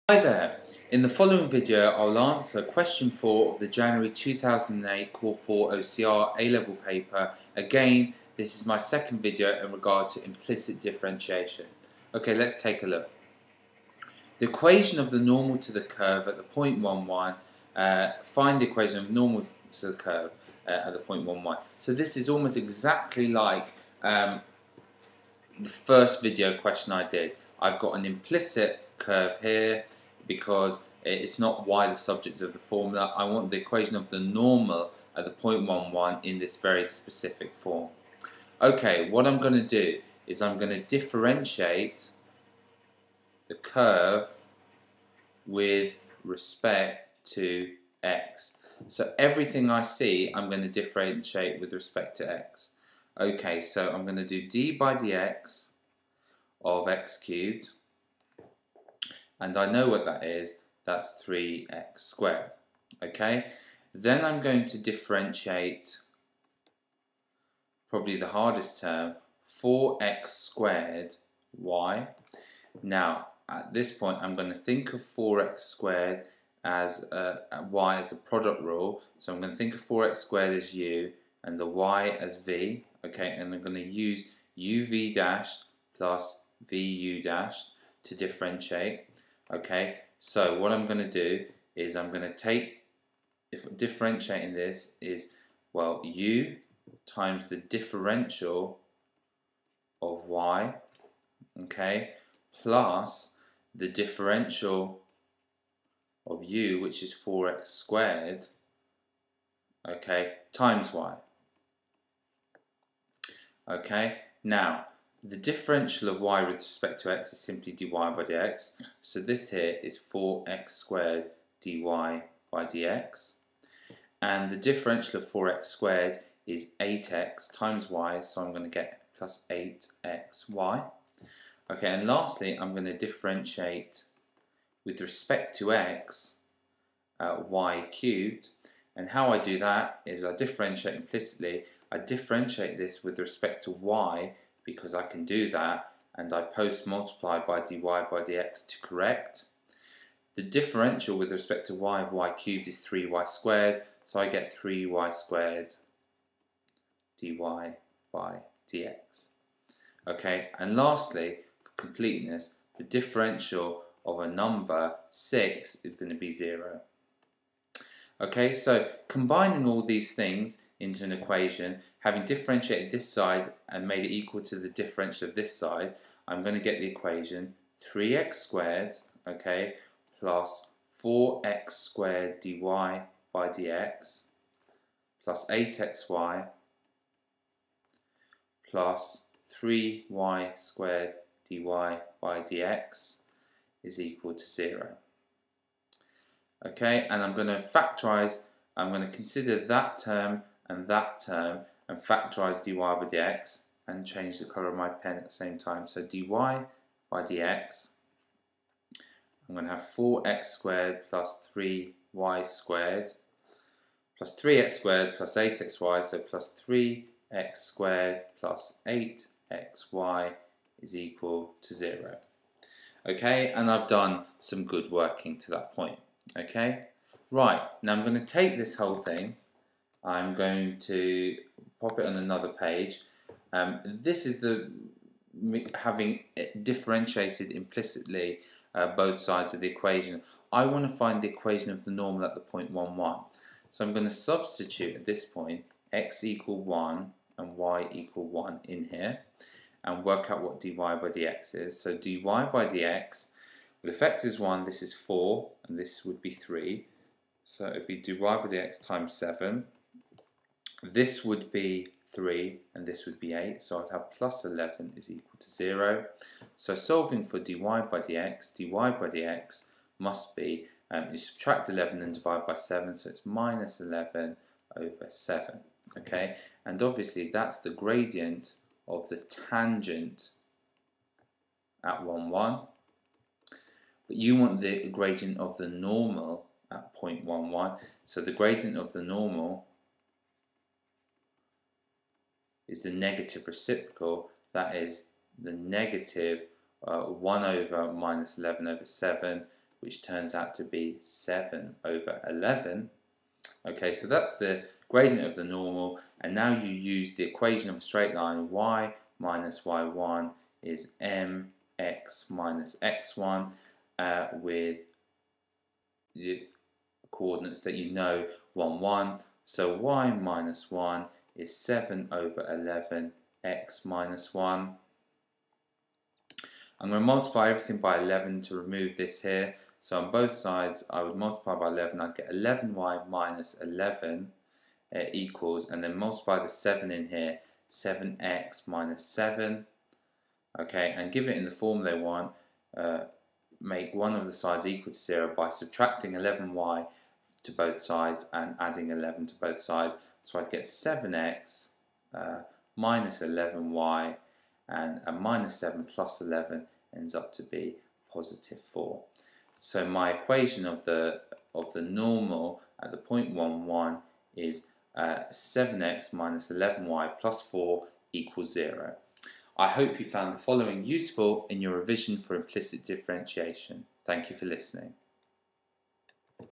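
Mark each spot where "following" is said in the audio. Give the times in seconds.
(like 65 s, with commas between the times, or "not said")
1 s, 370 s.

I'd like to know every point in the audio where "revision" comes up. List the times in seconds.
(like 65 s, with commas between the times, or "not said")
371 s.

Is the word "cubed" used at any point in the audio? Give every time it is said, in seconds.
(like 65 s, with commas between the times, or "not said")
57 s, 137 s, 152 s.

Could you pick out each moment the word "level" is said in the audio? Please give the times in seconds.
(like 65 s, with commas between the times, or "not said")
6 s.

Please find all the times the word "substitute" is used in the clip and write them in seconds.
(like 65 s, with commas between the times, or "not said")
244 s.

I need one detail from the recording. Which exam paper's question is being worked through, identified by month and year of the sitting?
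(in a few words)
January 2008.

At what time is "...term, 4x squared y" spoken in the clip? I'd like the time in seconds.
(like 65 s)
68 s.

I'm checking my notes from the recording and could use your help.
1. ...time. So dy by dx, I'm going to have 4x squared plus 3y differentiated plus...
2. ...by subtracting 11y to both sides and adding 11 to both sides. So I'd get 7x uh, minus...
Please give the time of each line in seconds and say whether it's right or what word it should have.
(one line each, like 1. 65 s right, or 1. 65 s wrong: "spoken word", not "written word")
1. 205 s wrong: "squared", not "differentiated"
2. 345 s right.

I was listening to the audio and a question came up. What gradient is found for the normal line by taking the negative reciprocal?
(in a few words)
7/11.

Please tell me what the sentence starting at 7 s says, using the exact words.
Again, this is my second video in regard to implicit differentiation.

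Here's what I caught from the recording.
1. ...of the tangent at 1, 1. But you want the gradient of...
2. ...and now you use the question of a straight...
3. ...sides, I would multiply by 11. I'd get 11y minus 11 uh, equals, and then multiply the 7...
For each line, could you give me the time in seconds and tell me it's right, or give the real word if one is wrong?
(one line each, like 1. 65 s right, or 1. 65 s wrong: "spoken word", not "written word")
1. 278 s right
2. 306 s wrong: "equation", not "question"
3. 330 s right.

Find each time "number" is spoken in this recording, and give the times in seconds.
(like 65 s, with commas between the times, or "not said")
164 s.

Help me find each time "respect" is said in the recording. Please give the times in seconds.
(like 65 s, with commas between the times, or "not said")
46 s, 51 s, 116 s, 135 s, 143 s, 151 s.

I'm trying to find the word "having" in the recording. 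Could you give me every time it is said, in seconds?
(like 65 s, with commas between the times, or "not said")
171 s, 235 s.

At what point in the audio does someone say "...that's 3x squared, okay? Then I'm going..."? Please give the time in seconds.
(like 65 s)
60 s.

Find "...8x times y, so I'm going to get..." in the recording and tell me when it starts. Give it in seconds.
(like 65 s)
126 s.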